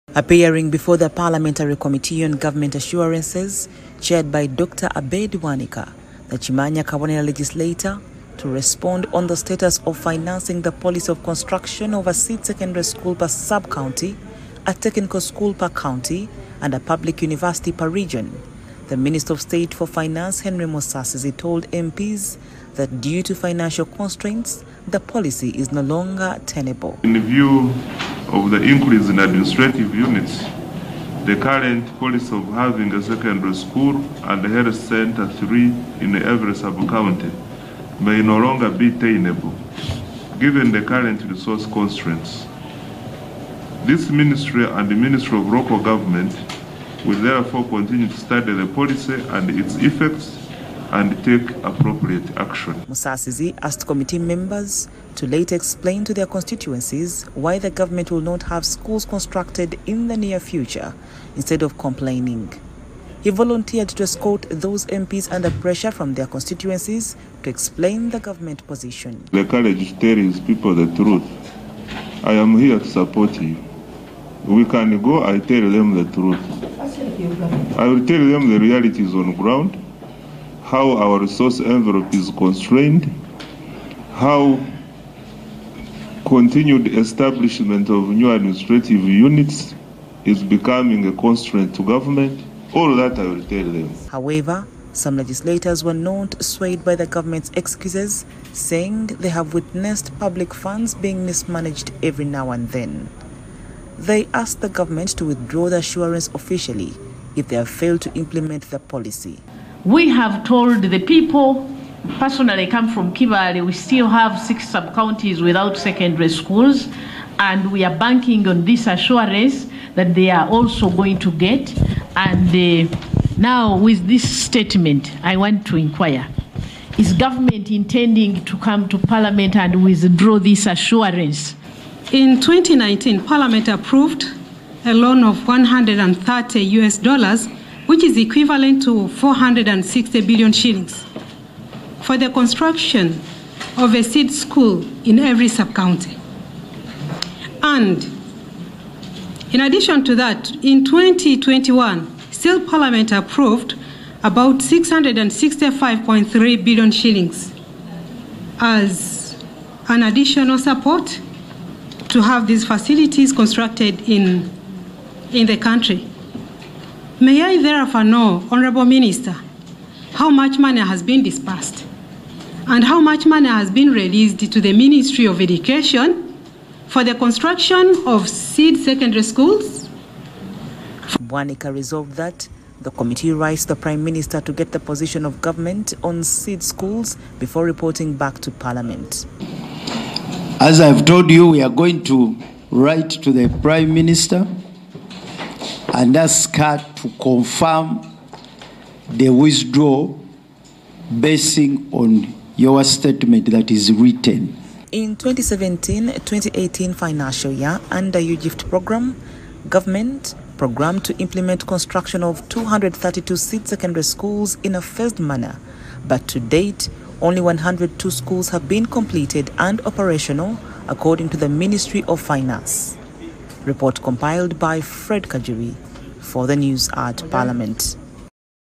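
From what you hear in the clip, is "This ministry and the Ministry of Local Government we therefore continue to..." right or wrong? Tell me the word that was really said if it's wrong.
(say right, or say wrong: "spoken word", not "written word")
right.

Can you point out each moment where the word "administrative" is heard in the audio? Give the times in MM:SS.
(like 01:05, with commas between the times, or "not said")
00:29, 01:28.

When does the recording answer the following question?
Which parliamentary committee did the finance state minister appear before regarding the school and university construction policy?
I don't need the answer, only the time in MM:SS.
00:01.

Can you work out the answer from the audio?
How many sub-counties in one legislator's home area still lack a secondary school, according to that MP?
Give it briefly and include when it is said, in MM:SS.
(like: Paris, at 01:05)
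6, at 01:54.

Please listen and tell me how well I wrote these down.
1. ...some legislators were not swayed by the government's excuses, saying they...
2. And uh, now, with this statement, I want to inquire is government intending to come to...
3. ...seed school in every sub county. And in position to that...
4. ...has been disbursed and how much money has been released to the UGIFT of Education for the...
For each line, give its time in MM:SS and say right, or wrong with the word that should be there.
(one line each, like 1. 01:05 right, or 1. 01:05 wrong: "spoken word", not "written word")
1. 01:34 right
2. 02:02 right
3. 02:24 wrong: "addition", not "position"
4. 02:50 wrong: "Ministry", not "UGIFT".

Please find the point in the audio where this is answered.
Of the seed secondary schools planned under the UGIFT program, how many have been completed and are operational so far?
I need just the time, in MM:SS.
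03:37.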